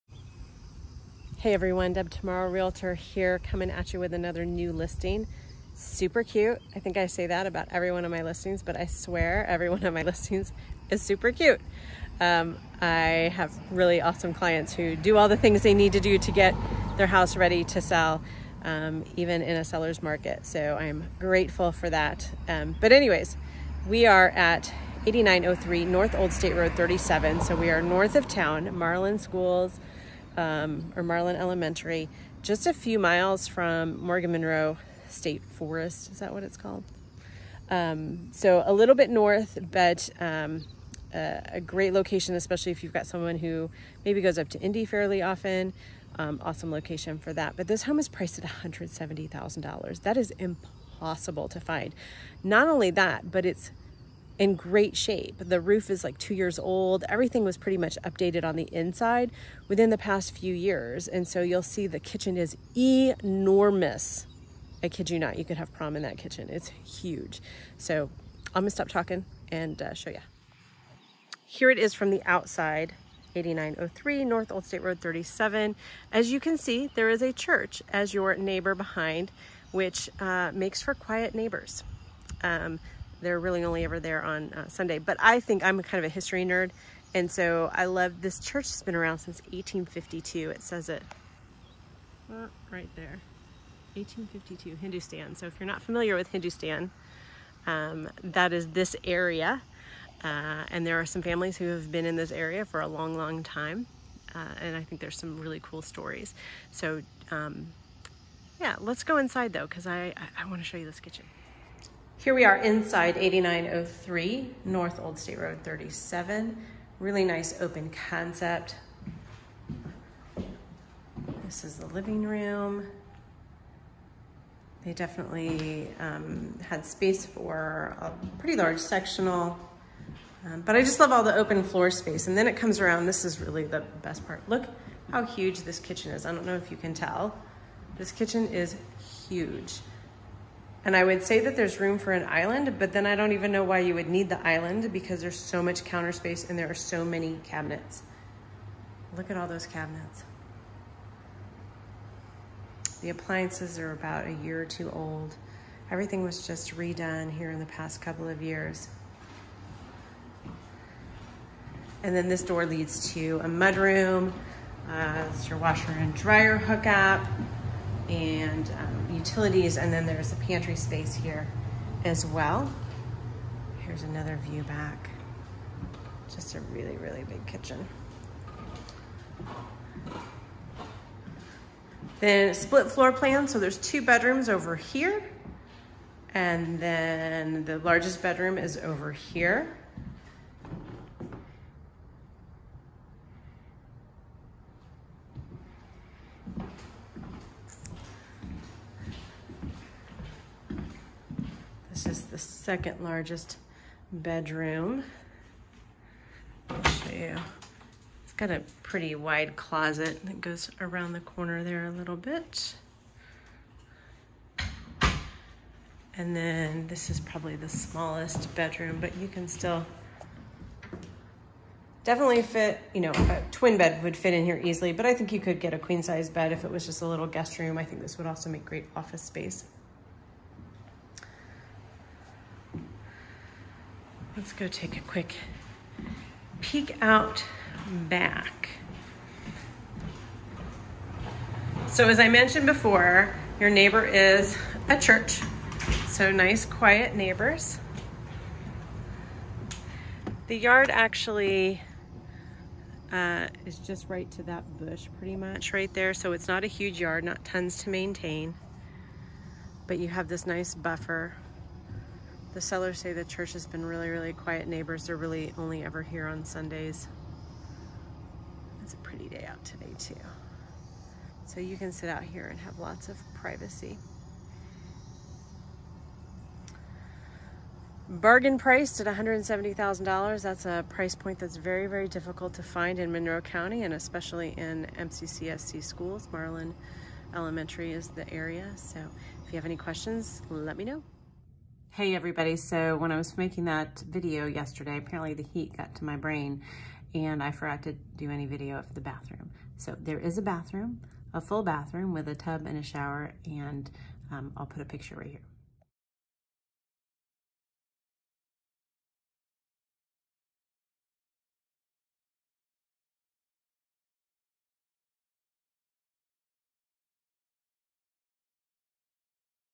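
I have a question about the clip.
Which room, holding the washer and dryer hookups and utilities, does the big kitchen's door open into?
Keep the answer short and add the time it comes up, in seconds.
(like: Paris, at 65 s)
mudroom, at 163 s.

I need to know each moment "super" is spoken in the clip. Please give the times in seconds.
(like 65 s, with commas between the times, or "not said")
5 s, 11 s.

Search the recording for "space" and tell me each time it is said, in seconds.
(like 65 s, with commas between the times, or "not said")
126 s, 131 s, 146 s, 170 s, 229 s.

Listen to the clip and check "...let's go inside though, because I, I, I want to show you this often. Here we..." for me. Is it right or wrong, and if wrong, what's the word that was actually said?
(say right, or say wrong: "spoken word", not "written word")
wrong: "kitchen", not "often".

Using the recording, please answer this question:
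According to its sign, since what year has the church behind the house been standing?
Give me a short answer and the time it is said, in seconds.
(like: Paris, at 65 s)
1852, at 89 s.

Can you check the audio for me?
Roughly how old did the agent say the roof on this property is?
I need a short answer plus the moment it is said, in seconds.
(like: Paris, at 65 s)
2 years, at 56 s.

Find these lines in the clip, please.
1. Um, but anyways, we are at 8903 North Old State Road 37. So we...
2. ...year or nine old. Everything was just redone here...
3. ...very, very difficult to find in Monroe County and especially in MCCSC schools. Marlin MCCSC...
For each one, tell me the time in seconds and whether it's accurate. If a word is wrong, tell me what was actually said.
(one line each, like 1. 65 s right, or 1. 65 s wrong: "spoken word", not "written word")
1. 22 s right
2. 154 s wrong: "two", not "nine"
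3. 281 s wrong: "Elementary", not "MCCSC".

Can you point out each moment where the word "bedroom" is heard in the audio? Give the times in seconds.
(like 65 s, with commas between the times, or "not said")
184 s, 188 s, 204 s, 218 s.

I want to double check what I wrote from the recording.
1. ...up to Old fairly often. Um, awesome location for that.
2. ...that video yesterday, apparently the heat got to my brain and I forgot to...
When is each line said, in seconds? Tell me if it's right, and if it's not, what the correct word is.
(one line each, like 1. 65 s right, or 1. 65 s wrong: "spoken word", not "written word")
1. 44 s wrong: "Indy", not "Old"
2. 293 s right.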